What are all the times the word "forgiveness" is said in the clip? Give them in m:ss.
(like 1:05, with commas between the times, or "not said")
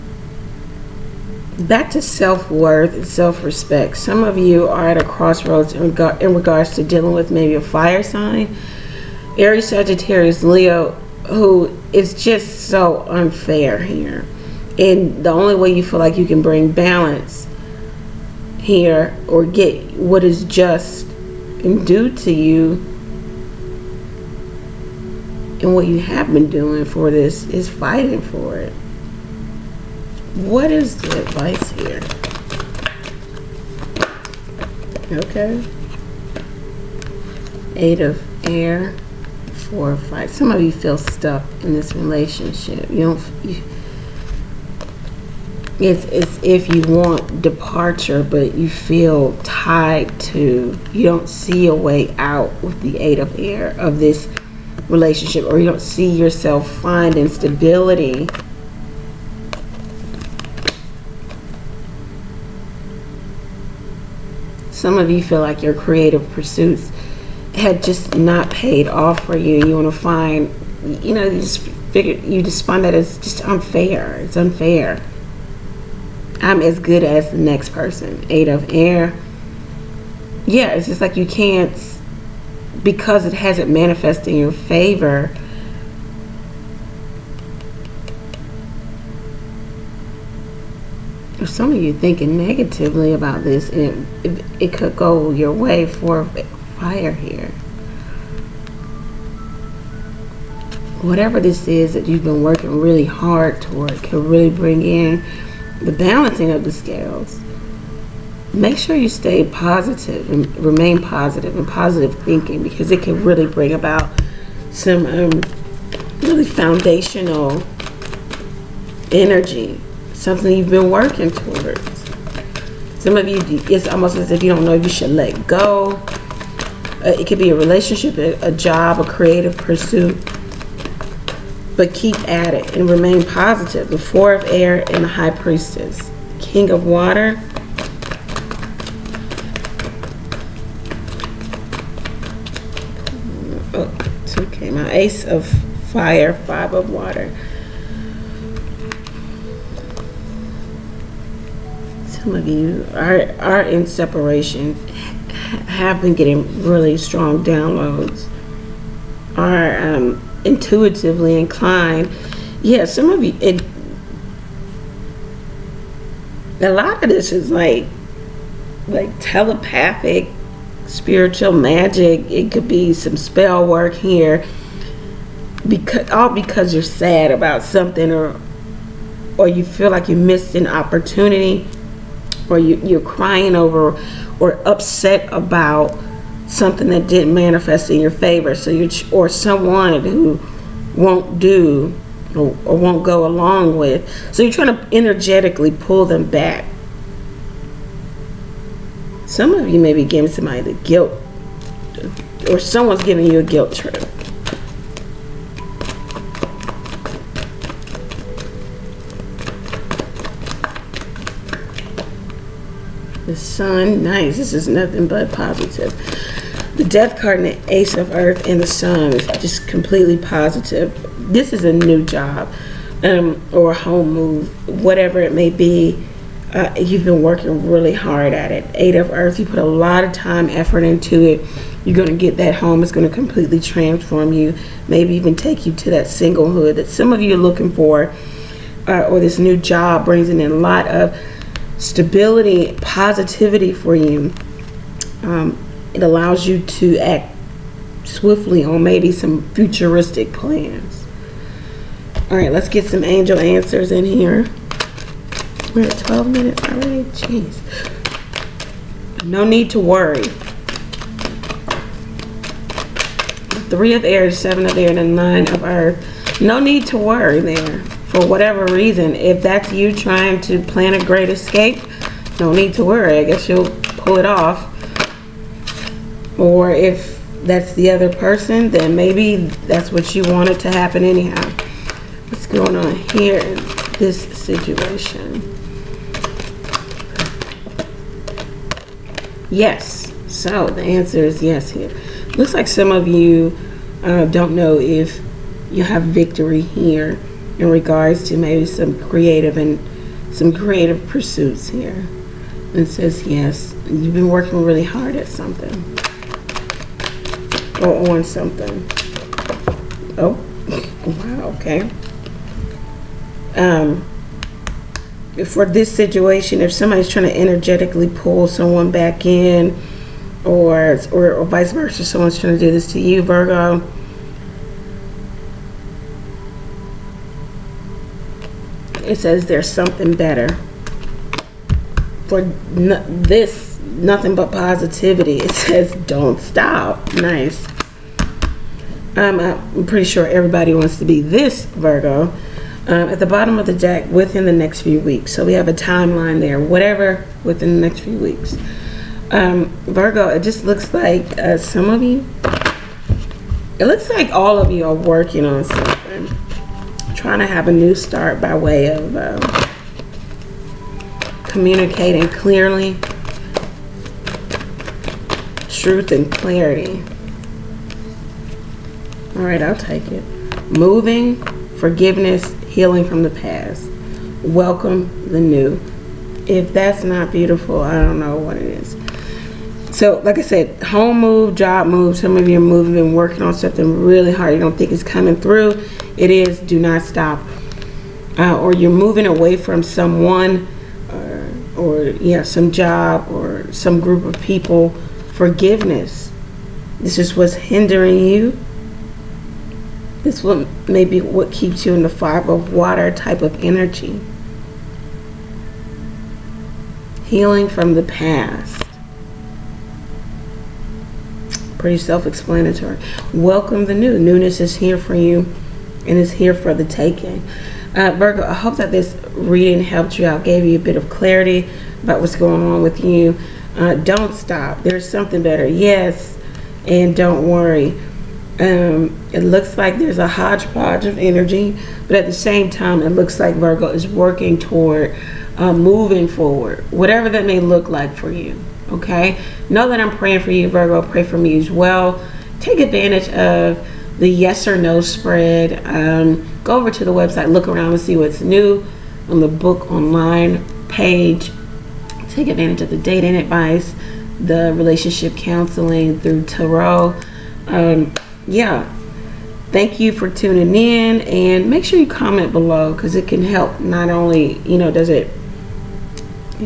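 6:11, 6:35.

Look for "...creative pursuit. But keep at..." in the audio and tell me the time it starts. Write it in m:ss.
2:09.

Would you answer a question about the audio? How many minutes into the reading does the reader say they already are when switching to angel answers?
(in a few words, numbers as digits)
12.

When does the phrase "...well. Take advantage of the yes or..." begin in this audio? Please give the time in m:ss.
7:21.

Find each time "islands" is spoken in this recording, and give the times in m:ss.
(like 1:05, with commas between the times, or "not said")
not said.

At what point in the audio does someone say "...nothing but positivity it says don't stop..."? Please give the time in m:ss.
5:33.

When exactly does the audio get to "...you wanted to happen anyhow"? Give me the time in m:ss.
4:40.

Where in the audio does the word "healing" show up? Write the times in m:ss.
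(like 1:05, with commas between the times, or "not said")
6:12, 6:47.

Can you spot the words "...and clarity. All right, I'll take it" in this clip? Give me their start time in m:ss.
6:06.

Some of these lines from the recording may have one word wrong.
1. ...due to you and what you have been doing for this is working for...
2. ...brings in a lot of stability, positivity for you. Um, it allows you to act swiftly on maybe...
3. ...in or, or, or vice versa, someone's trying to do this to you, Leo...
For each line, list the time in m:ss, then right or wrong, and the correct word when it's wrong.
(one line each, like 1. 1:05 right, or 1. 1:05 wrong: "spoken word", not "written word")
1. 0:21 wrong: "fighting", not "working"
2. 4:00 right
3. 5:19 wrong: "Virgo", not "Leo".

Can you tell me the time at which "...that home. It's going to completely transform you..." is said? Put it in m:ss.
3:52.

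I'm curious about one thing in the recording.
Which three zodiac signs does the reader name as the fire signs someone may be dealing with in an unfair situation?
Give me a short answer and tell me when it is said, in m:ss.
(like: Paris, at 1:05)
Aries, Sagittarius, Leo, at 0:09.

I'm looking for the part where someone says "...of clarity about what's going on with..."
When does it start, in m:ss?
7:00.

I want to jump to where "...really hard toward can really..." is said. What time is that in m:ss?
1:42.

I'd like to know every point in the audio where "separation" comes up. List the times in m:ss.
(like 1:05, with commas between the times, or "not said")
2:33.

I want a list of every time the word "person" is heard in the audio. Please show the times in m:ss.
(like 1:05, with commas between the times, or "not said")
1:17, 4:38.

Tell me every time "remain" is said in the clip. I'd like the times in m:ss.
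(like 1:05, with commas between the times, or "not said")
1:50, 2:12.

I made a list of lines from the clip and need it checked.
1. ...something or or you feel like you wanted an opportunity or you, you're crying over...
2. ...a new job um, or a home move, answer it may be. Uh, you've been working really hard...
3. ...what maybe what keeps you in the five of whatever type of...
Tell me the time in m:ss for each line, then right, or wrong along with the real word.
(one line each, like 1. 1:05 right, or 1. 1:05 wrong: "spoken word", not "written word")
1. 2:57 wrong: "missed", not "wanted"
2. 3:41 wrong: "whatever", not "answer"
3. 6:40 wrong: "water", not "whatever".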